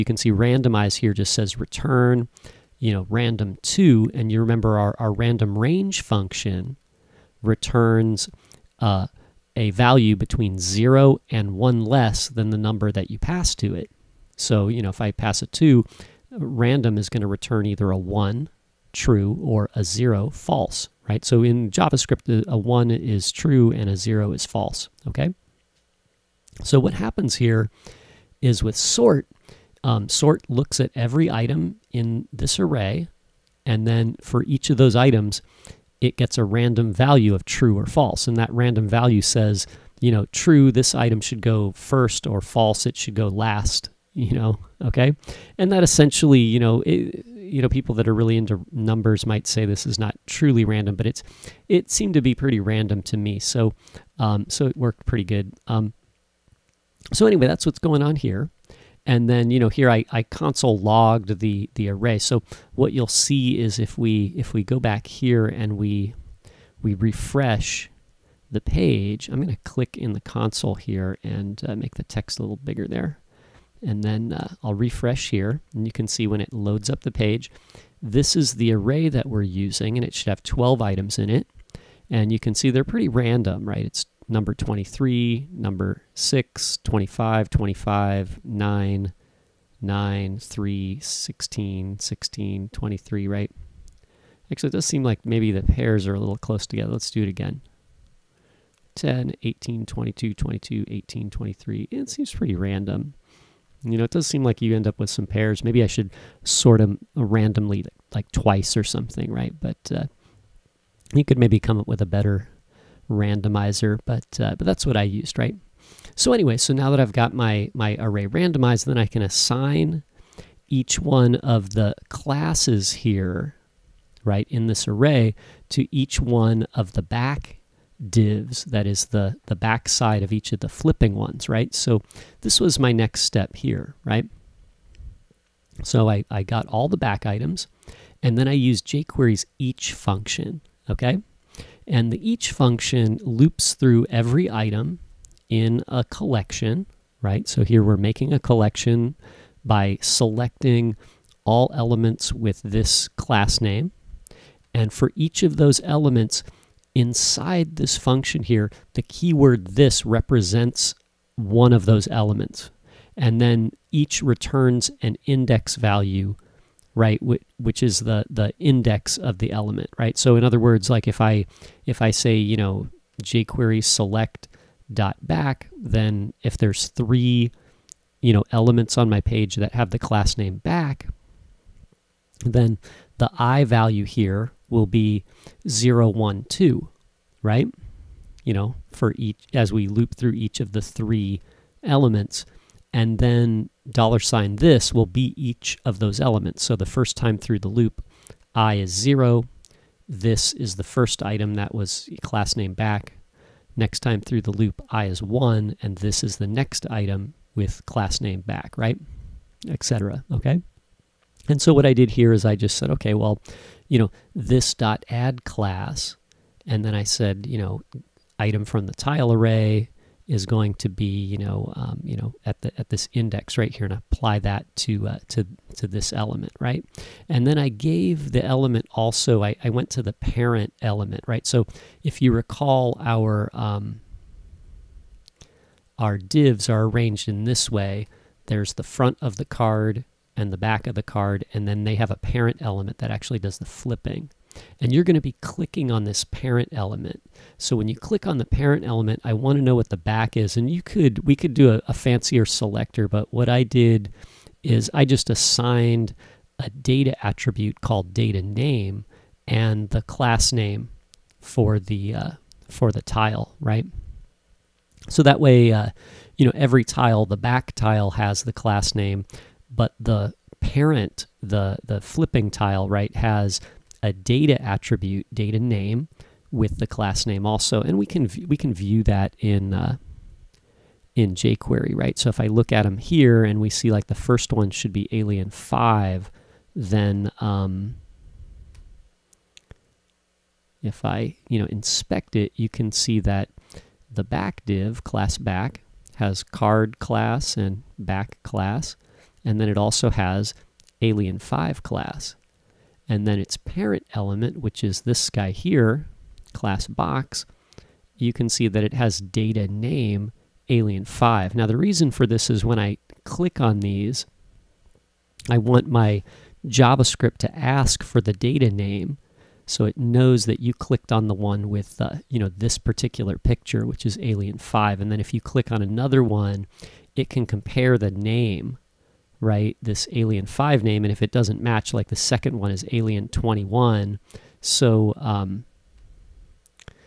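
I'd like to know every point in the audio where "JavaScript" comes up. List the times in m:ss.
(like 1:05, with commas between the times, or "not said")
0:21, 5:16.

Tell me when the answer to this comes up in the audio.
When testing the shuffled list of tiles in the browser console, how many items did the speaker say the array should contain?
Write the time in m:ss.
1:20.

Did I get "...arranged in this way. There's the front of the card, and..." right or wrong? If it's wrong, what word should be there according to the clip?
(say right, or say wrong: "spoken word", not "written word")
right.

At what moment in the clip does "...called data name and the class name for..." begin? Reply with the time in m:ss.
4:17.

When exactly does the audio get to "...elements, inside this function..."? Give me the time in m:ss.
2:35.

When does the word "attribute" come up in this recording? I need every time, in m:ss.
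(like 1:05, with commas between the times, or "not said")
4:17, 4:34.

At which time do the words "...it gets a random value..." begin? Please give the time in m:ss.
0:35.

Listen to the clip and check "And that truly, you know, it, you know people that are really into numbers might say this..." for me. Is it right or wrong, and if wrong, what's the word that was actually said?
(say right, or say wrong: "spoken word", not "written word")
wrong: "essentially", not "truly".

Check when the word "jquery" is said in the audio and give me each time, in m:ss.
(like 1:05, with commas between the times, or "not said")
2:18, 2:53, 4:41.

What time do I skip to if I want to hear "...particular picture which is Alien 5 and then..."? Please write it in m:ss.
5:22.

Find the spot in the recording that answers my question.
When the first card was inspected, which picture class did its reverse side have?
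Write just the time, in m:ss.
4:45.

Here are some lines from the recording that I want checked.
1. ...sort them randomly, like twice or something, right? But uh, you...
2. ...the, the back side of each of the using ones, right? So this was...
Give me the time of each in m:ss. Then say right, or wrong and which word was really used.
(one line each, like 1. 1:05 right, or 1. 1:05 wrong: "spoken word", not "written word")
1. 1:46 right
2. 2:09 wrong: "flipping", not "using".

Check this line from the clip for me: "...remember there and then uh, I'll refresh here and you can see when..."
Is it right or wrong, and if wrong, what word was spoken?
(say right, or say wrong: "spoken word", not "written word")
wrong: "bigger", not "remember".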